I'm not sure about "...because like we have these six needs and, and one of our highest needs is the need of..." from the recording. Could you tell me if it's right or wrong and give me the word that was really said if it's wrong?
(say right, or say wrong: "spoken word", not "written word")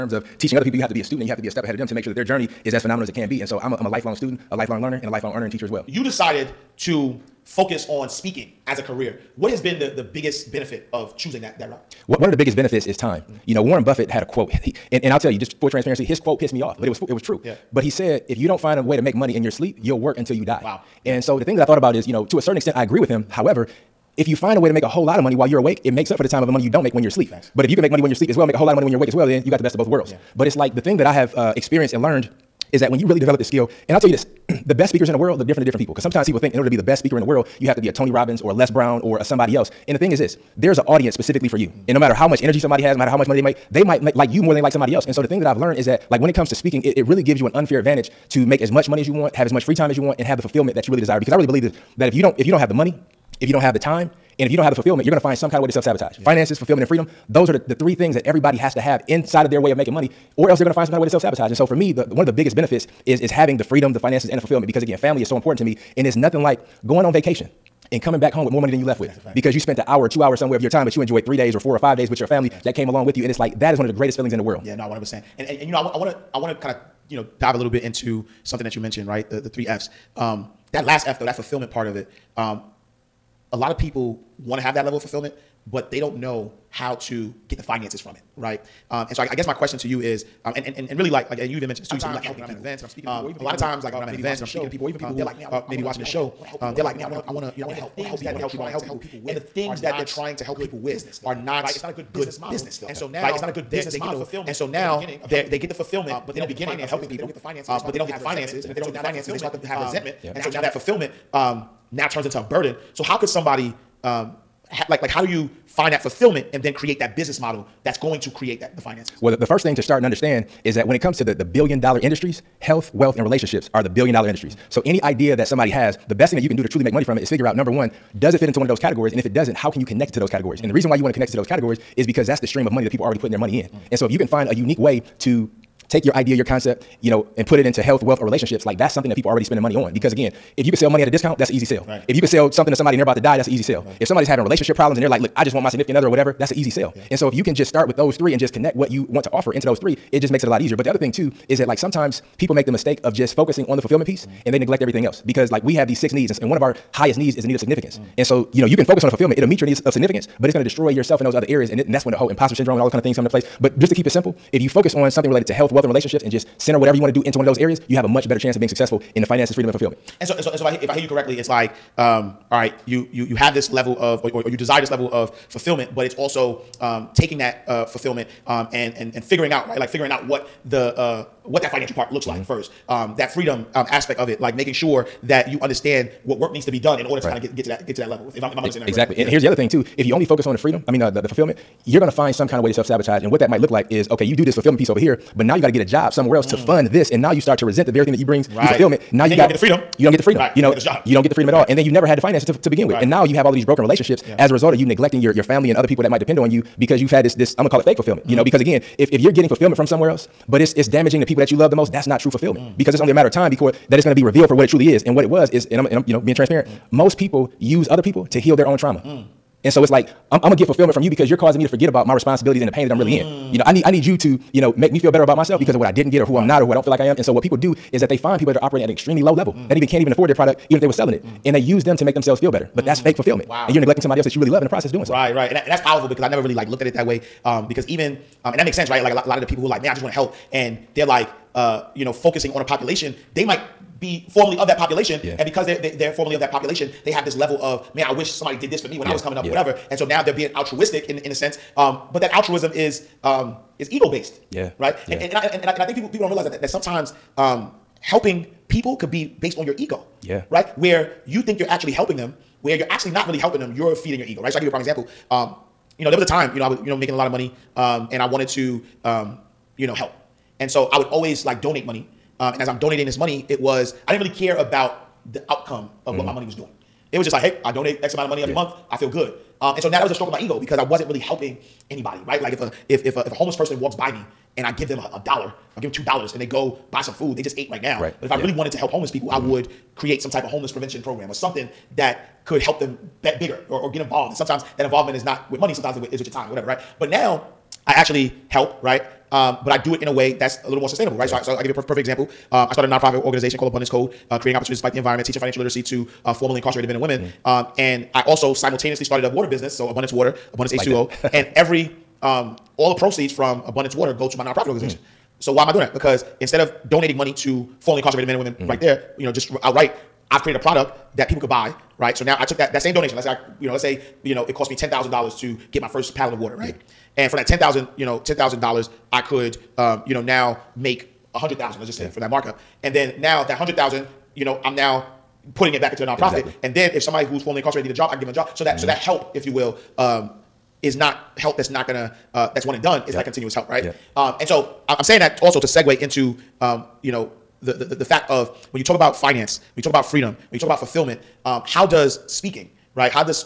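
right.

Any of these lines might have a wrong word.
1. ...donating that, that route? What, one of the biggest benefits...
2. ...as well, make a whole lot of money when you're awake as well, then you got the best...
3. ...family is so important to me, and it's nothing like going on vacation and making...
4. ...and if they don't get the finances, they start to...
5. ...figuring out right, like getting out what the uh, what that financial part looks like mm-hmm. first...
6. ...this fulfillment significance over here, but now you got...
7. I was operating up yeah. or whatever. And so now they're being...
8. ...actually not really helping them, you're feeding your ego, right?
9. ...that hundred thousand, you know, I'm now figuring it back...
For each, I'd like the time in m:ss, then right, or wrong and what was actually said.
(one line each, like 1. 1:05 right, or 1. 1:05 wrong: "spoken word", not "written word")
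1. 0:11 wrong: "choosing", not "donating"
2. 0:28 right
3. 1:04 wrong: "coming", not "making"
4. 1:48 right
5. 2:59 wrong: "figuring", not "getting"
6. 3:14 wrong: "piece", not "significance"
7. 4:09 wrong: "coming", not "operating"
8. 4:22 right
9. 5:33 wrong: "putting", not "figuring".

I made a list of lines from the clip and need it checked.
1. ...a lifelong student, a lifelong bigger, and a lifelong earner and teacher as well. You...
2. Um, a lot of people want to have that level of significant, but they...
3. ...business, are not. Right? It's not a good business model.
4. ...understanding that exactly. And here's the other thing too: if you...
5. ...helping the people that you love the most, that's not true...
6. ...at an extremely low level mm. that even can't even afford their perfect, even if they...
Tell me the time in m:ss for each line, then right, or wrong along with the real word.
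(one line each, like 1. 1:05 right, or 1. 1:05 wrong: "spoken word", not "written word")
1. 0:03 wrong: "learner", not "bigger"
2. 1:22 wrong: "fulfillment", not "significant"
3. 1:41 right
4. 3:08 right
5. 3:30 wrong: "damaging", not "helping"
6. 3:48 wrong: "product", not "perfect".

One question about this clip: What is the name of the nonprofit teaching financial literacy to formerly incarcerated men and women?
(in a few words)
Abundance Code.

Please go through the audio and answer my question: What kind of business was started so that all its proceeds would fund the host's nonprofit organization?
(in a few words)
A water business.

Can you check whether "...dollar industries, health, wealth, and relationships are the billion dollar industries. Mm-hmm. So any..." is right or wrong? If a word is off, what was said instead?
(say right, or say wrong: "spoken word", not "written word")
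right.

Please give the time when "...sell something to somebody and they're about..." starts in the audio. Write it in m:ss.
2:22.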